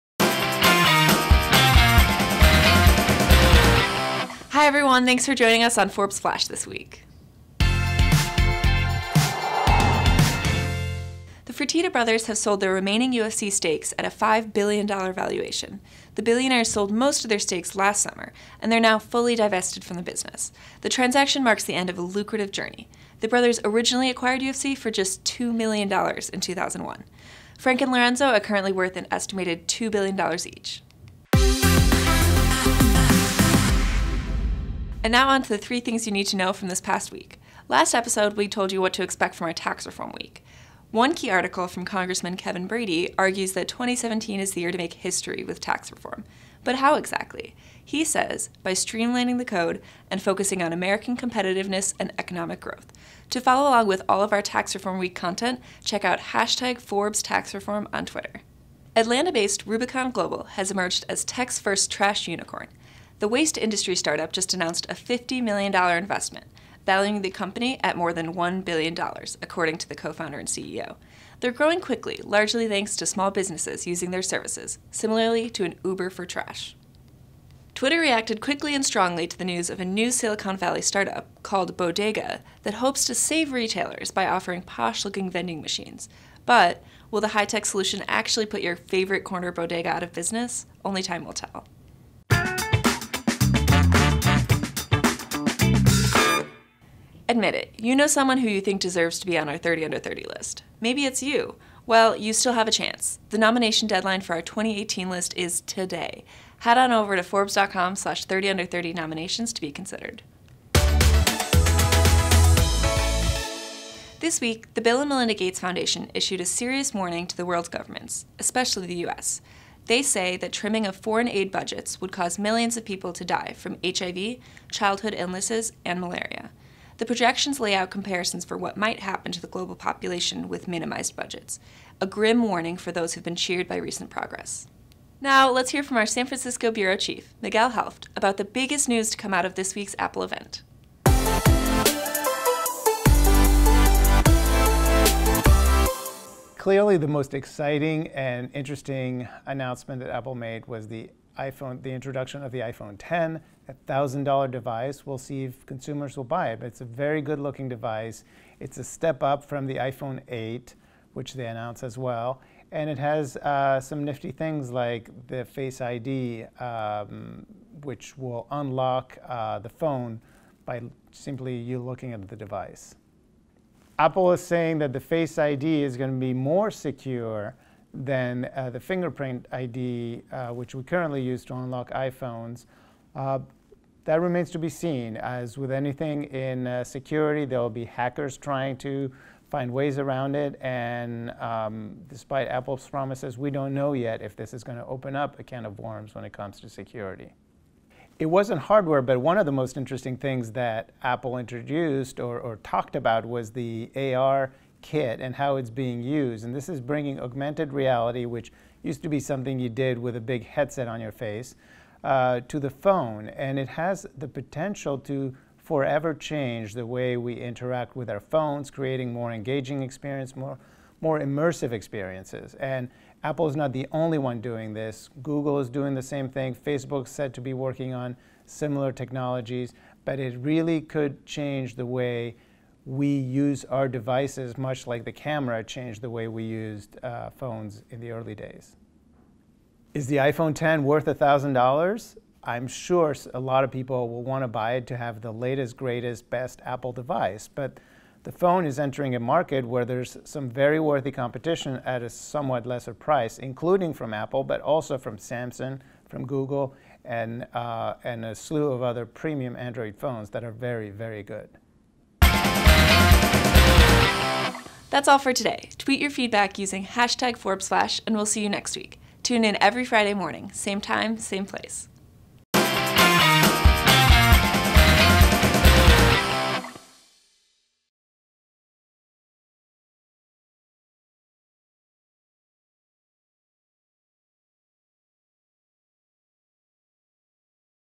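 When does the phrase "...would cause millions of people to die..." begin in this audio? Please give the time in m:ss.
2:02.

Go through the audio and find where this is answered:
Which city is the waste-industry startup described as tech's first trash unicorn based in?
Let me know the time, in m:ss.
0:58.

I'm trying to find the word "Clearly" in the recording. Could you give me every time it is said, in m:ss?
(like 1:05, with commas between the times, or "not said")
2:26.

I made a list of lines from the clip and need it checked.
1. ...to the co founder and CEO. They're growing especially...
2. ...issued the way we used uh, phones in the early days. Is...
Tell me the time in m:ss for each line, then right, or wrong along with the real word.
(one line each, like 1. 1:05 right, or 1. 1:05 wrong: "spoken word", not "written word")
1. 1:09 wrong: "quickly", not "especially"
2. 3:55 wrong: "changed", not "issued".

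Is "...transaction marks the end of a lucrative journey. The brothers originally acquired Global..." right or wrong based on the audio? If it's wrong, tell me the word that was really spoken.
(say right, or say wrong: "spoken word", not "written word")
wrong: "UFC", not "Global".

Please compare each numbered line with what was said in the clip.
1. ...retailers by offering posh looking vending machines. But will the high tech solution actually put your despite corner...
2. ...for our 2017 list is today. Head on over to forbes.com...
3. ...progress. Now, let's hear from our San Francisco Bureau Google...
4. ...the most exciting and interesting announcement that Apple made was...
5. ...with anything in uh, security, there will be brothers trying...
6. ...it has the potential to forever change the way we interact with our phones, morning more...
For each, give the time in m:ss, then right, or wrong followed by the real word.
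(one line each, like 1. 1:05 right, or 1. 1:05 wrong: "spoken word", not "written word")
1. 1:23 wrong: "favorite", not "despite"
2. 1:44 wrong: "2018", not "2017"
3. 2:14 wrong: "Chief", not "Google"
4. 2:26 right
5. 3:05 wrong: "hackers", not "brothers"
6. 3:33 wrong: "creating", not "morning".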